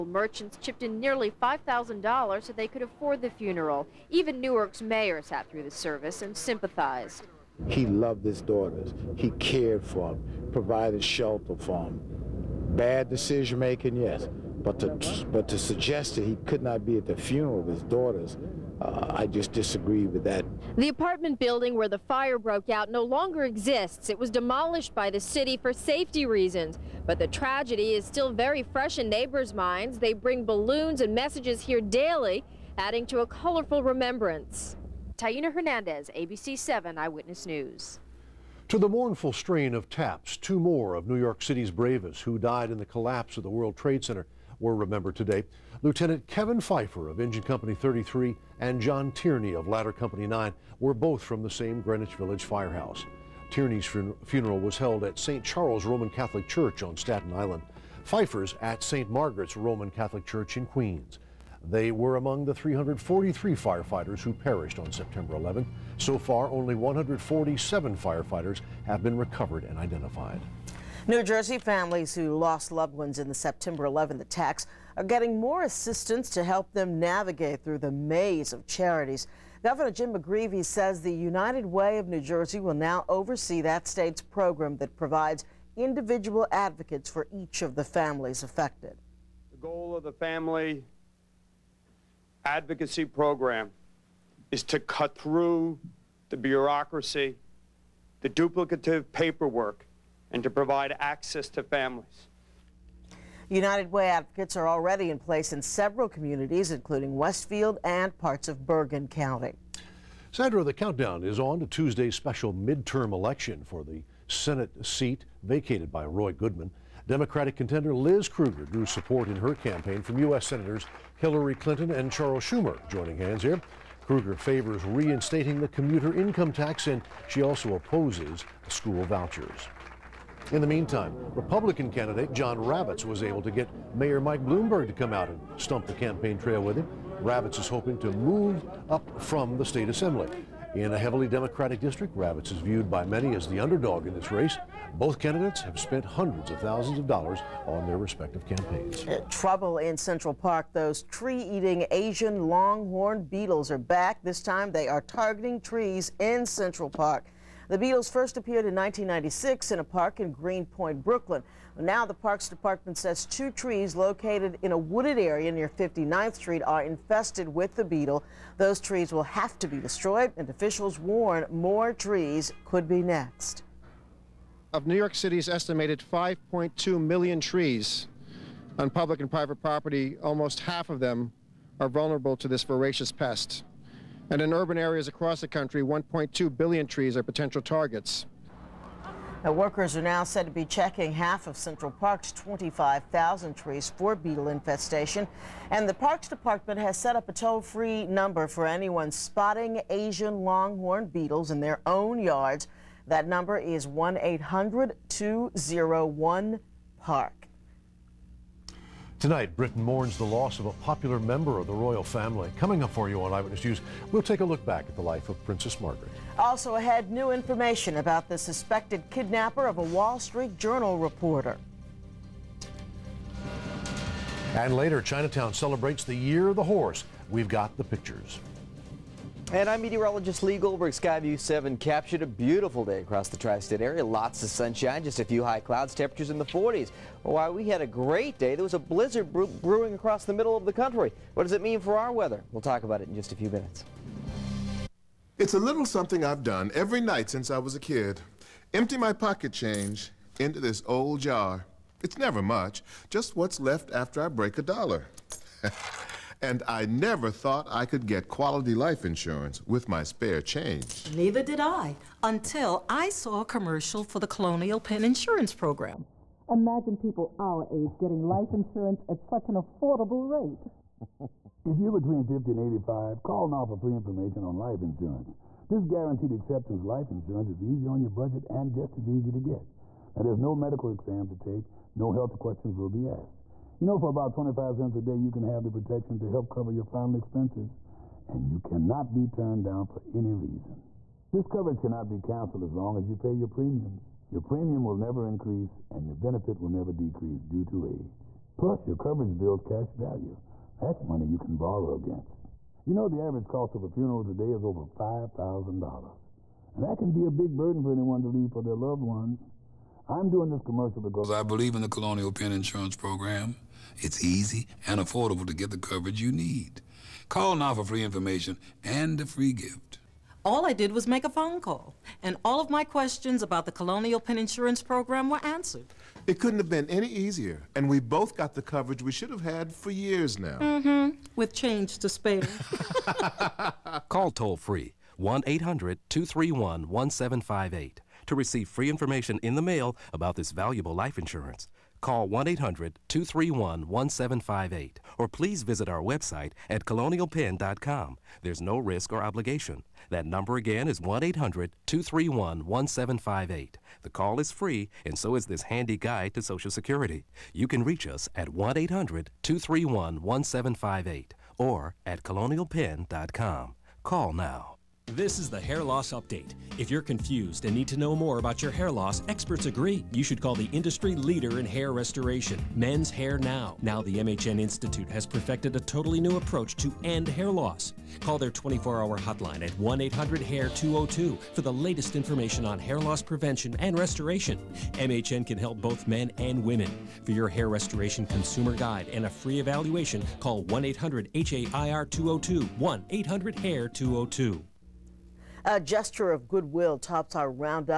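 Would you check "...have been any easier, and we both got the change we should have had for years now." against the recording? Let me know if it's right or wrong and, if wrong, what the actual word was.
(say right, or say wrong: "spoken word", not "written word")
wrong: "coverage", not "change".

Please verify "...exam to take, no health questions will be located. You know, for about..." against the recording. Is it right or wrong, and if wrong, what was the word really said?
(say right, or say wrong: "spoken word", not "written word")
wrong: "asked", not "located".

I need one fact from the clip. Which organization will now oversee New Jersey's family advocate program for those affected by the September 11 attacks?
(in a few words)
United Way of New Jersey.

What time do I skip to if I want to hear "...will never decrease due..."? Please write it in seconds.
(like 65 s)
296 s.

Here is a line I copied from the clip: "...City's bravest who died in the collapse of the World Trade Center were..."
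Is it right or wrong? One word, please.
right.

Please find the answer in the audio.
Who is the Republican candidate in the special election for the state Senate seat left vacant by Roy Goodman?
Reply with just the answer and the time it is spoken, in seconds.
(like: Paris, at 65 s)
John Ravitz, at 132 s.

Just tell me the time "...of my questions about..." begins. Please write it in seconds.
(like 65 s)
322 s.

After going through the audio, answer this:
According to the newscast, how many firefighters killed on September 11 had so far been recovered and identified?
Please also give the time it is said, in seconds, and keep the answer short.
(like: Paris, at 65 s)
147, at 66 s.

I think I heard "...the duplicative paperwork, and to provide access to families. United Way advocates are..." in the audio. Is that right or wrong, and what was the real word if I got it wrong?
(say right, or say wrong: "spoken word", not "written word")
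right.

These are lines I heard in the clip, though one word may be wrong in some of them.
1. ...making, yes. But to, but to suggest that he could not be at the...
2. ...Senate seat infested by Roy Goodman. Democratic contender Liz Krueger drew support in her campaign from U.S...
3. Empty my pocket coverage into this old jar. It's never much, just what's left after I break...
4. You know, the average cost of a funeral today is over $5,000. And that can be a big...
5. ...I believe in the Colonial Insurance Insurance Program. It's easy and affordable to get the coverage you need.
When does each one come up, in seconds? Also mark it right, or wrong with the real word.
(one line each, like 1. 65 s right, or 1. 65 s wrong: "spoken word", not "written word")
1. 13 s right
2. 114 s wrong: "vacated", not "infested"
3. 248 s wrong: "change", not "coverage"
4. 302 s right
5. 311 s wrong: "Penn", not "Insurance".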